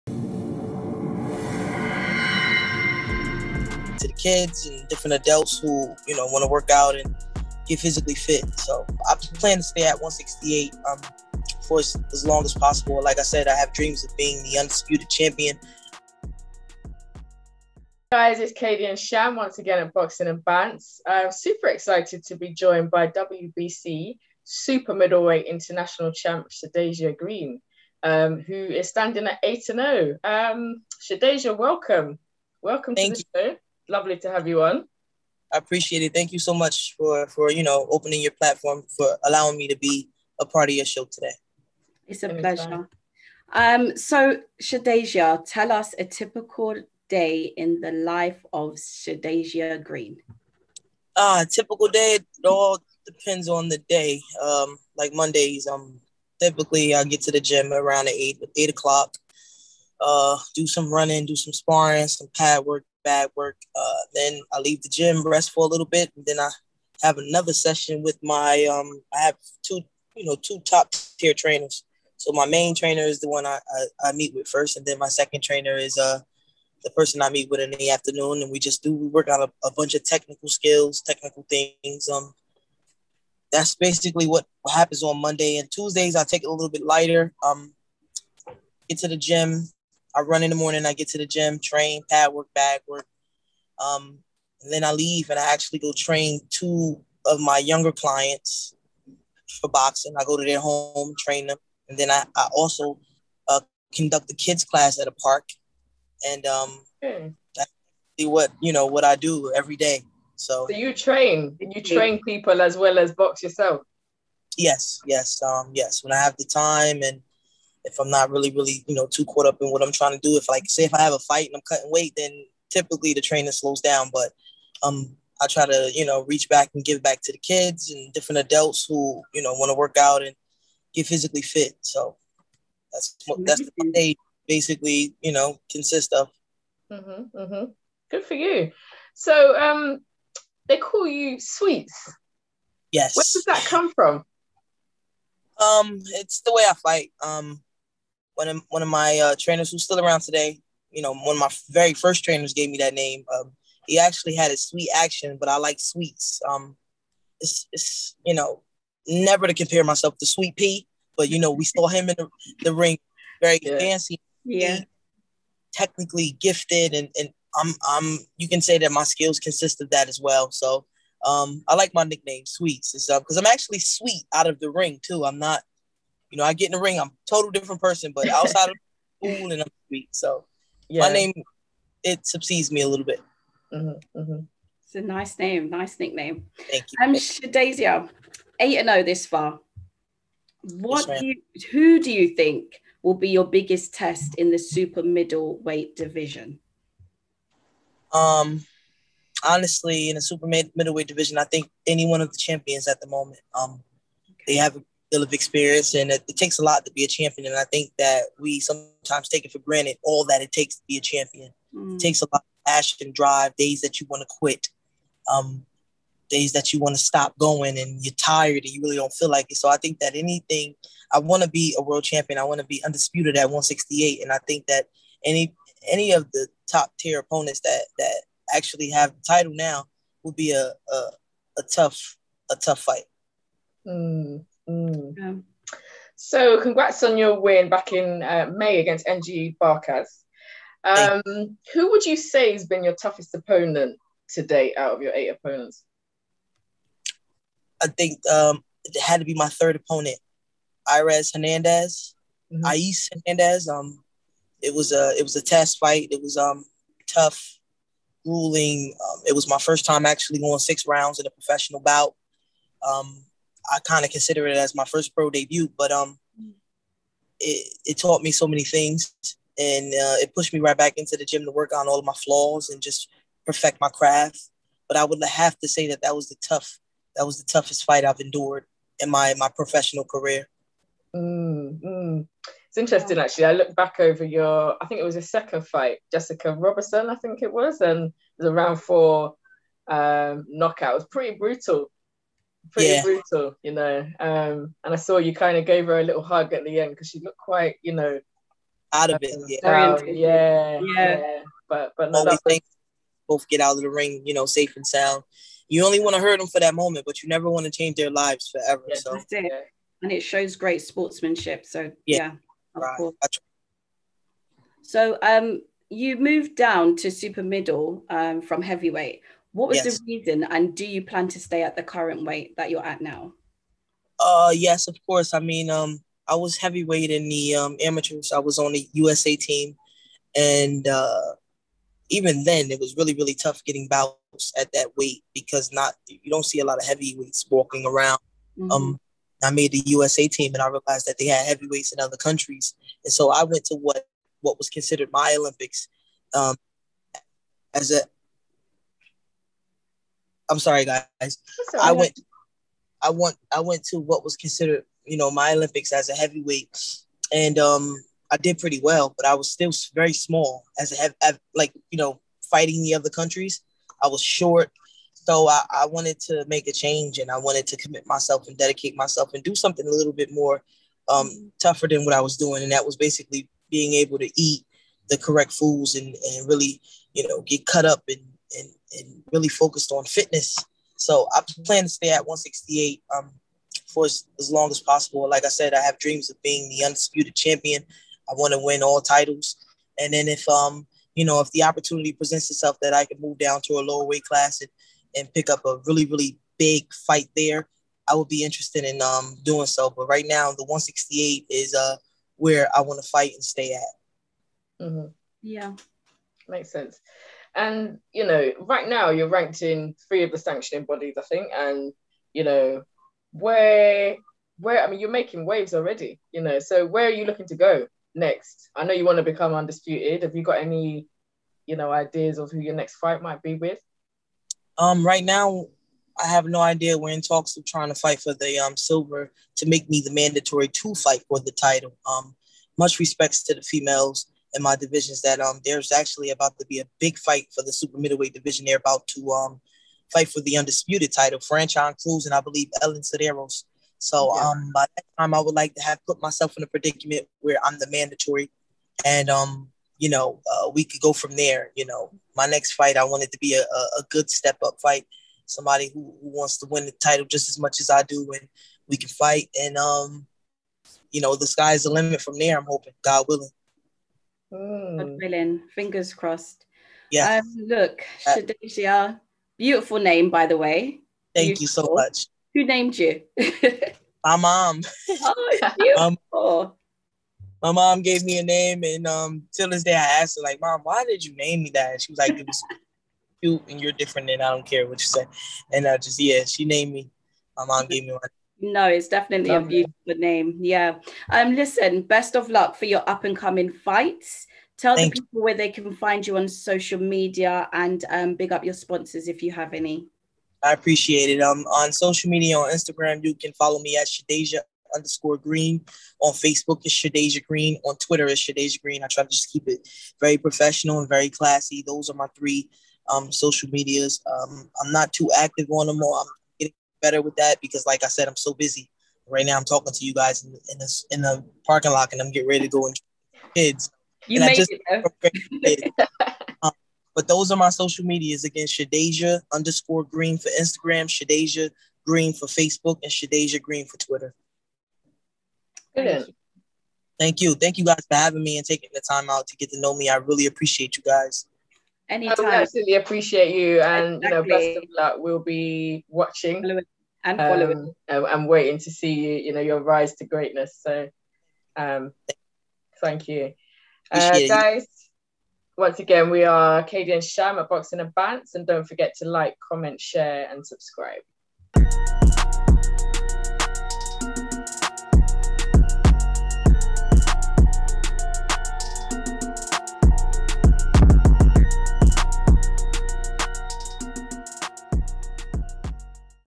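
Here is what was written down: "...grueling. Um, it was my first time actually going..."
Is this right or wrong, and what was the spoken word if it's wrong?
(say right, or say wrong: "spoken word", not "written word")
right.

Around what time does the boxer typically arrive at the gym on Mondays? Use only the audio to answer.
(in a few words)
8 o'clock.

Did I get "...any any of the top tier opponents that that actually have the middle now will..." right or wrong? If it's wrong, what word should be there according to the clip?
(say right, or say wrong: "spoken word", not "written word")
wrong: "title", not "middle".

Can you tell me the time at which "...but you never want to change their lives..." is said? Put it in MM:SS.
05:07.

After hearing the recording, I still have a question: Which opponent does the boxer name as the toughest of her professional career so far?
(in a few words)
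Irez Hernandez.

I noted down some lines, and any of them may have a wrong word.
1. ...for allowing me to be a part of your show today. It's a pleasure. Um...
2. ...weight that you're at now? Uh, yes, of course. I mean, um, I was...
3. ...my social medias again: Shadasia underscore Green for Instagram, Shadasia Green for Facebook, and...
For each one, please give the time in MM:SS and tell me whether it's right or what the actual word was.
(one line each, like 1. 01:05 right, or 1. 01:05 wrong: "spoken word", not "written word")
1. 00:38 right
2. 05:22 right
3. 08:47 right.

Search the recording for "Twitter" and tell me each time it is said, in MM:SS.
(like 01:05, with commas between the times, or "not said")
08:27, 08:53.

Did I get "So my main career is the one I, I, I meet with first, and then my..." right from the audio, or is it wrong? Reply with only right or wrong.
wrong.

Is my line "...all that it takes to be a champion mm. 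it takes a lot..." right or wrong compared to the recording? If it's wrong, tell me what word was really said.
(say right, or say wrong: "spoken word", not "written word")
right.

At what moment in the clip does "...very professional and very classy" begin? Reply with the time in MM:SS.
08:30.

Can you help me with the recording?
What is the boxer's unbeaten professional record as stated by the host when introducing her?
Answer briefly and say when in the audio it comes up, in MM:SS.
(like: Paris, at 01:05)
8 and 0, at 00:29.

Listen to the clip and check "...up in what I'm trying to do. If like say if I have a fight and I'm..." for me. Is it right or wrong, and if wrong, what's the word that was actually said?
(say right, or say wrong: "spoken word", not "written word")
right.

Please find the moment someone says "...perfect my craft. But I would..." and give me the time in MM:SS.
04:33.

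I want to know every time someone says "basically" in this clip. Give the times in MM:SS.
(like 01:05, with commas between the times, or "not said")
01:23, 02:14, 06:12.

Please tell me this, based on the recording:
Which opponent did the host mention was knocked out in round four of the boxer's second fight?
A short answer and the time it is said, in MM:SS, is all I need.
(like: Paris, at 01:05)
Jessica Robertson, at 04:46.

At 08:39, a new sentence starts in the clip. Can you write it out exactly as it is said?
Right now, I'm talking to you guys in, in, this, in the parking lot, and I'm getting ready to go and kids.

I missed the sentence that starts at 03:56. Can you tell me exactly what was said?
So, congrats on your win back in uh, May against NG Barcas.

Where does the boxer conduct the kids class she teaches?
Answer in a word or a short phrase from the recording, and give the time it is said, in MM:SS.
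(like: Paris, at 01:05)
At a park, at 01:45.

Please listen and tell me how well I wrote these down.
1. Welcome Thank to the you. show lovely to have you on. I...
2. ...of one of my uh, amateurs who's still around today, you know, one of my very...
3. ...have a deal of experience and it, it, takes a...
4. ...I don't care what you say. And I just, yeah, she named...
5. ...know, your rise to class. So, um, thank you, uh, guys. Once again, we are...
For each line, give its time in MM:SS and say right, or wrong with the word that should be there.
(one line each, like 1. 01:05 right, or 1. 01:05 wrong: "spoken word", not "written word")
1. 00:32 right
2. 02:28 wrong: "trainers", not "amateurs"
3. 03:24 right
4. 08:04 right
5. 09:09 wrong: "greatness", not "class".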